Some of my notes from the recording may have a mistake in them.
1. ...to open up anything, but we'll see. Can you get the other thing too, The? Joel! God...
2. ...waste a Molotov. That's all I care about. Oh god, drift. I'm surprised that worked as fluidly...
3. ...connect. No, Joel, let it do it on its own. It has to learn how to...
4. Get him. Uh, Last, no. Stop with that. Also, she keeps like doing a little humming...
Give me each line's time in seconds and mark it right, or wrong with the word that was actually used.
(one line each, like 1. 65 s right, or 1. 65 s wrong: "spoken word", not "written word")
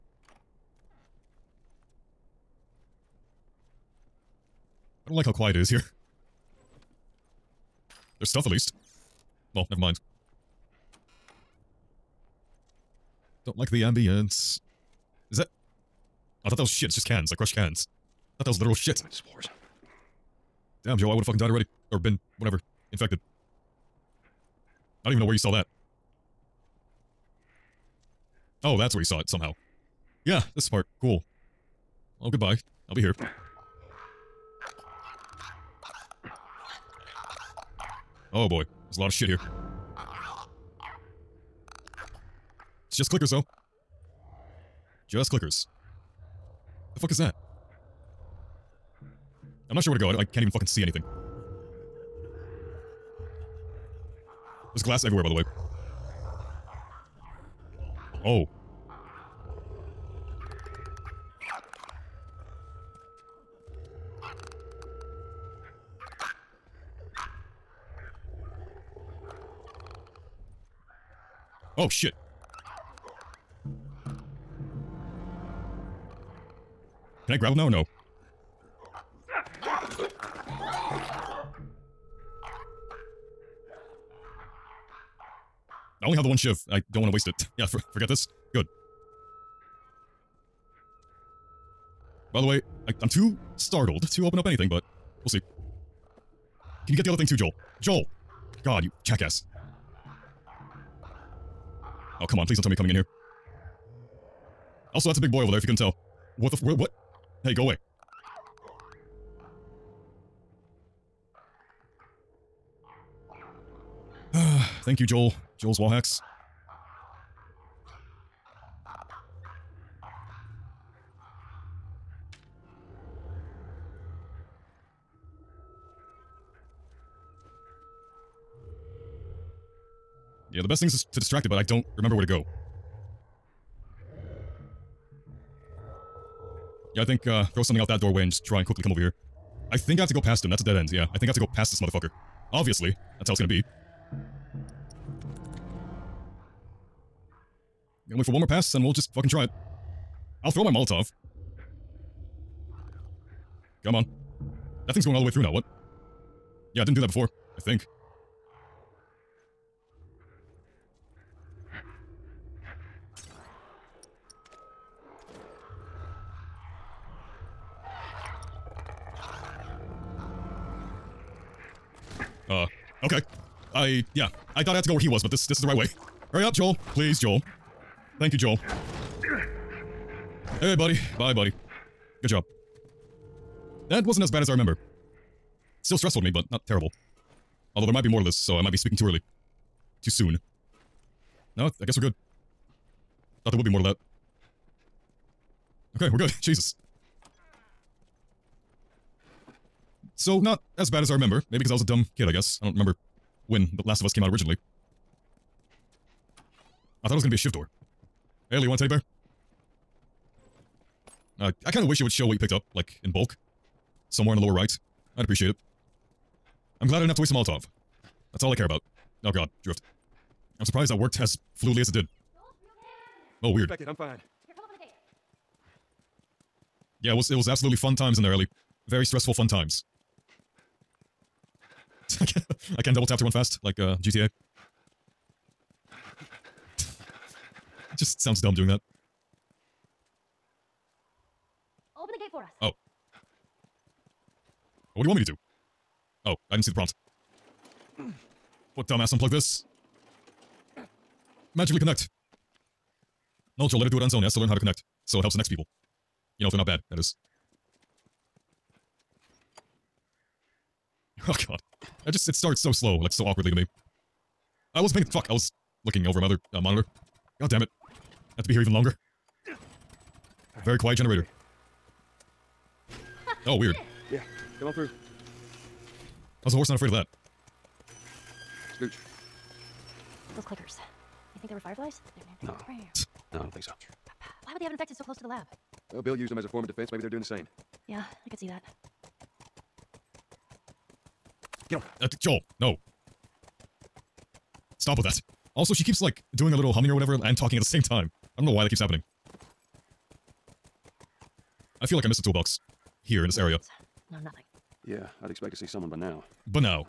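1. 94 s wrong: "Joel", not "The"
2. 217 s right
3. 251 s right
4. 291 s wrong: "Joel", not "Last".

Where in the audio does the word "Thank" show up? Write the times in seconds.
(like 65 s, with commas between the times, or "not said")
114 s, 178 s.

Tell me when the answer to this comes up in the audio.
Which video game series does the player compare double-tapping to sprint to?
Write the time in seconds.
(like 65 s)
234 s.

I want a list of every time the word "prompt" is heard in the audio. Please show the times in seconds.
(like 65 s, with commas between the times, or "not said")
246 s.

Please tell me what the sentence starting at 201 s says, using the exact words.
Maybe because I was a dumb kid, I guess.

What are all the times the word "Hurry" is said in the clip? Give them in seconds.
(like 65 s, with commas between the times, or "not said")
176 s.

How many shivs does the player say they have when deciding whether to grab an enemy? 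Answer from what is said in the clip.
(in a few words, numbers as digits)
1.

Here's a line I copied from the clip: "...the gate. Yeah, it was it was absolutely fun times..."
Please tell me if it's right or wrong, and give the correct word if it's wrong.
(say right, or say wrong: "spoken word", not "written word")
right.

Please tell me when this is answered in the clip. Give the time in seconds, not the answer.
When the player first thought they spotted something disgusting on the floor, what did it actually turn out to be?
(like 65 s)
16 s.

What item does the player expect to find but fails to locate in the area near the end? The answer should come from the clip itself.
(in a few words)
a toolbox.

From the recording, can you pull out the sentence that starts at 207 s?
I thought it was gonna be a shiv door.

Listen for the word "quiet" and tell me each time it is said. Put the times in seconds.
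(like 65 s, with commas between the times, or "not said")
5 s, 270 s.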